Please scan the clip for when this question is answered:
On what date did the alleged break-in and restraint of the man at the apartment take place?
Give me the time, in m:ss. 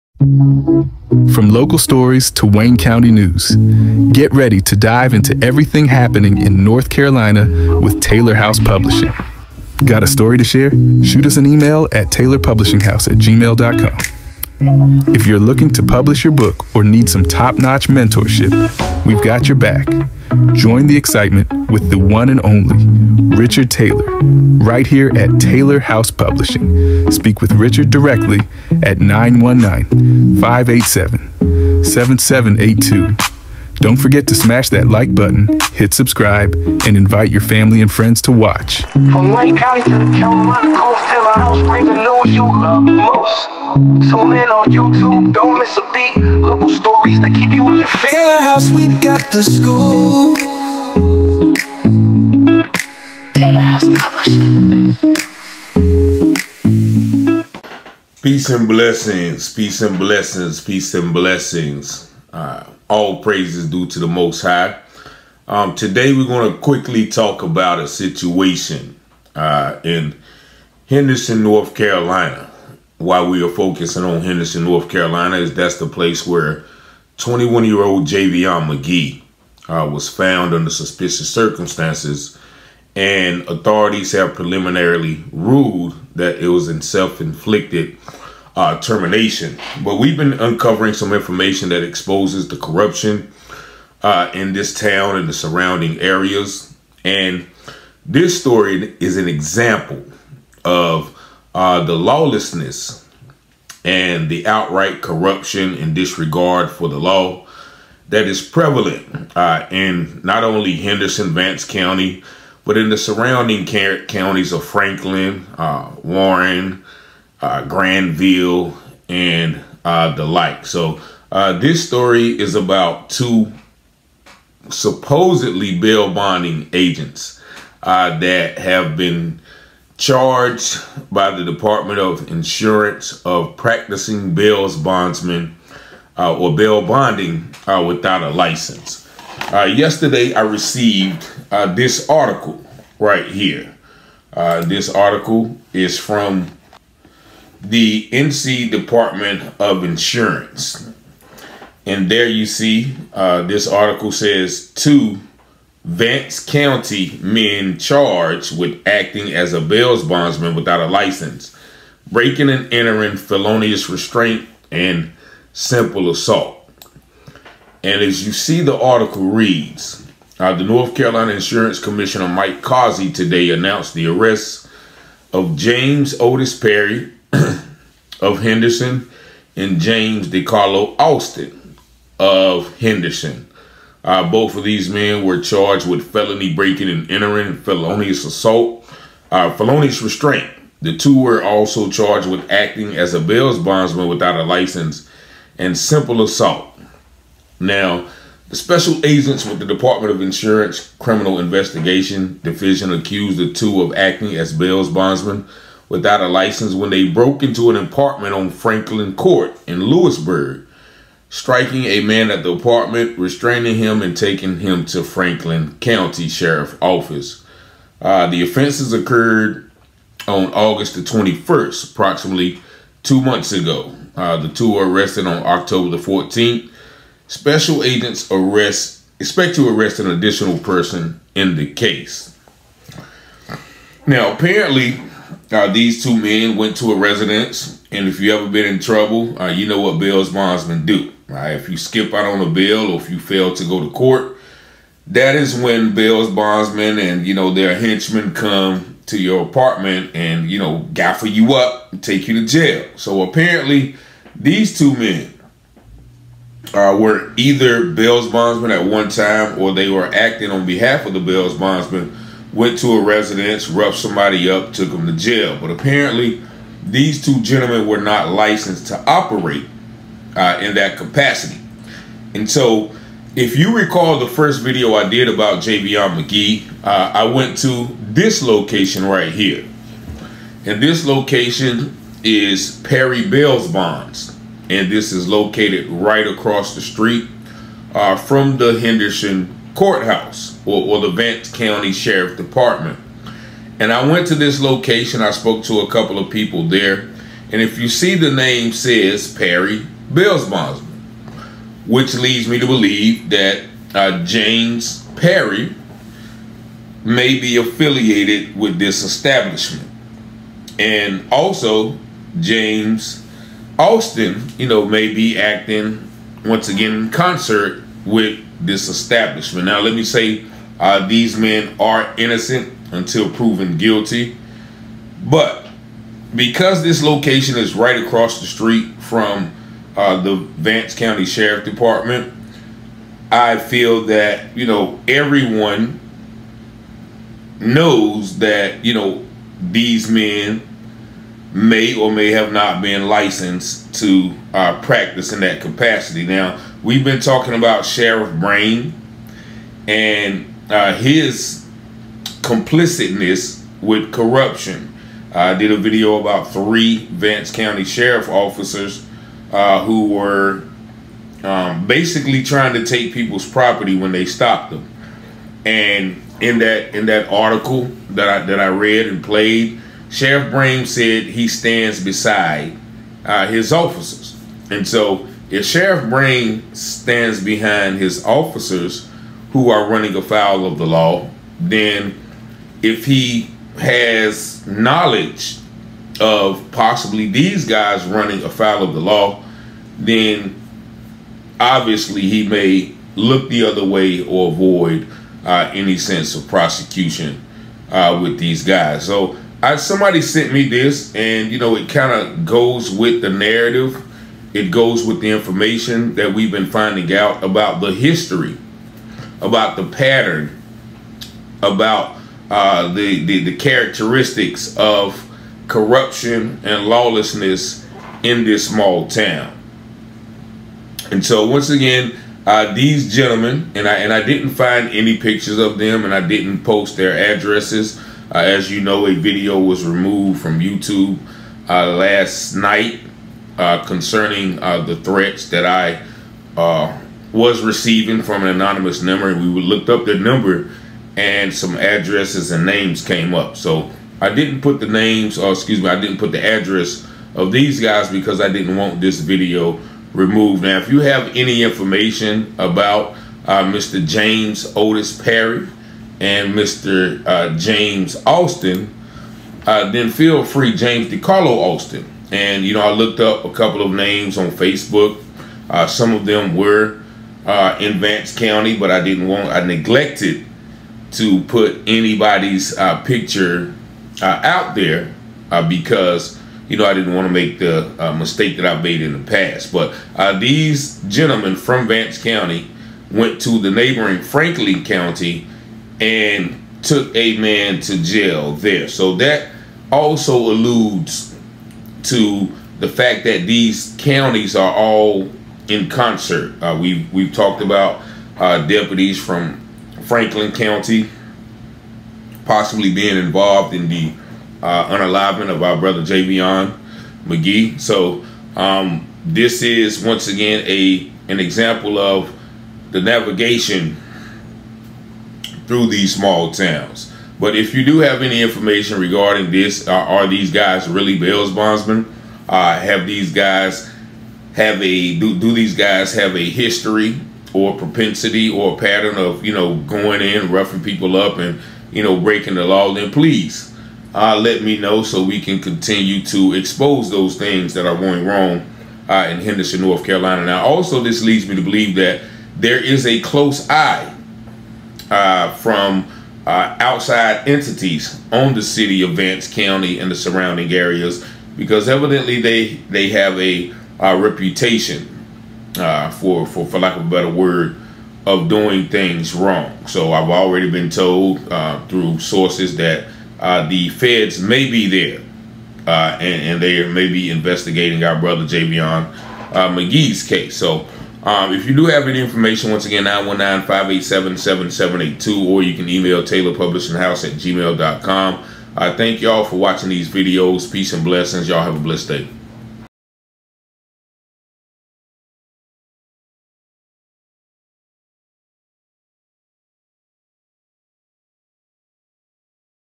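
3:40.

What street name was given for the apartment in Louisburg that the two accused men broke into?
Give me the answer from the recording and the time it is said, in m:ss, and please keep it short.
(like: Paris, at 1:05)
Franklin Court, at 3:28.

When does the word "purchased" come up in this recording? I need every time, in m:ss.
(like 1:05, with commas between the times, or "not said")
not said.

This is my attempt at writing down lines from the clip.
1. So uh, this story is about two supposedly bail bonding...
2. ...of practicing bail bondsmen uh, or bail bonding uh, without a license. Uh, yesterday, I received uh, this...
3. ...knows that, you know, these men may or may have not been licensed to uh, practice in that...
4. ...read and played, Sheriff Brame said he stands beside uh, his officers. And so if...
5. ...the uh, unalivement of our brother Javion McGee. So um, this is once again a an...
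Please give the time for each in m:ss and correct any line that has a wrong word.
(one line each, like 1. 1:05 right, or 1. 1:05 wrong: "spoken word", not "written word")
1. 2:00 right
2. 2:13 right
3. 5:37 right
4. 6:08 right
5. 8:23 right.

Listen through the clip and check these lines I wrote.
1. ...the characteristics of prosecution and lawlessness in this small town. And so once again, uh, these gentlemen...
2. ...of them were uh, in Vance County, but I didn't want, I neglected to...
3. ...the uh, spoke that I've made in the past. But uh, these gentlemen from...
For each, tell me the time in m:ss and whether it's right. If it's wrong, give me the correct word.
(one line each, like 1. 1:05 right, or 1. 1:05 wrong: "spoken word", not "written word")
1. 6:53 wrong: "corruption", not "prosecution"
2. 7:46 right
3. 7:57 wrong: "mistake", not "spoke".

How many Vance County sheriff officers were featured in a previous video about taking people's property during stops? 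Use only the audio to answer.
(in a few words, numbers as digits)
3.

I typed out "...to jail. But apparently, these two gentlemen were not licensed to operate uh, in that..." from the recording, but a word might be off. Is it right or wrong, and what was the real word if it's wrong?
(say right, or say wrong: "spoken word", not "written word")
right.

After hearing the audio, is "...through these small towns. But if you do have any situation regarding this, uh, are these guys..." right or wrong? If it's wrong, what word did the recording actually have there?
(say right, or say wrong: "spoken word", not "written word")
wrong: "information", not "situation".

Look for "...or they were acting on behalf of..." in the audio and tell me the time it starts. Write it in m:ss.
4:19.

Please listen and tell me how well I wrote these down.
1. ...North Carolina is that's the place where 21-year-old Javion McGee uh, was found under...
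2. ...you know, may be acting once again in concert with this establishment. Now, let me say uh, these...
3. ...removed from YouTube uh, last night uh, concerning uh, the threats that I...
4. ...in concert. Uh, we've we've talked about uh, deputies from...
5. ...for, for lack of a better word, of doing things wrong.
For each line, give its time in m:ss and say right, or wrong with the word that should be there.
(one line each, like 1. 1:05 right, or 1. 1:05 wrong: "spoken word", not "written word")
1. 1:14 right
2. 5:14 right
3. 7:09 right
4. 8:15 right
5. 9:16 right.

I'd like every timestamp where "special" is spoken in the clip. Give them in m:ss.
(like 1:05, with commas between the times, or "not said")
3:18, 3:47.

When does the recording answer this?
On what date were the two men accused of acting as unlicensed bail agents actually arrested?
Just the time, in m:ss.
3:45.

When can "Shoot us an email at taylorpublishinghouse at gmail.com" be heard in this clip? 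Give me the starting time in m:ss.
0:11.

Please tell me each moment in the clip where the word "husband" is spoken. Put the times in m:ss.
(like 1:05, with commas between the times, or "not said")
not said.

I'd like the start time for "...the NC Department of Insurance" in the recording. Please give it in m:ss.
2:27.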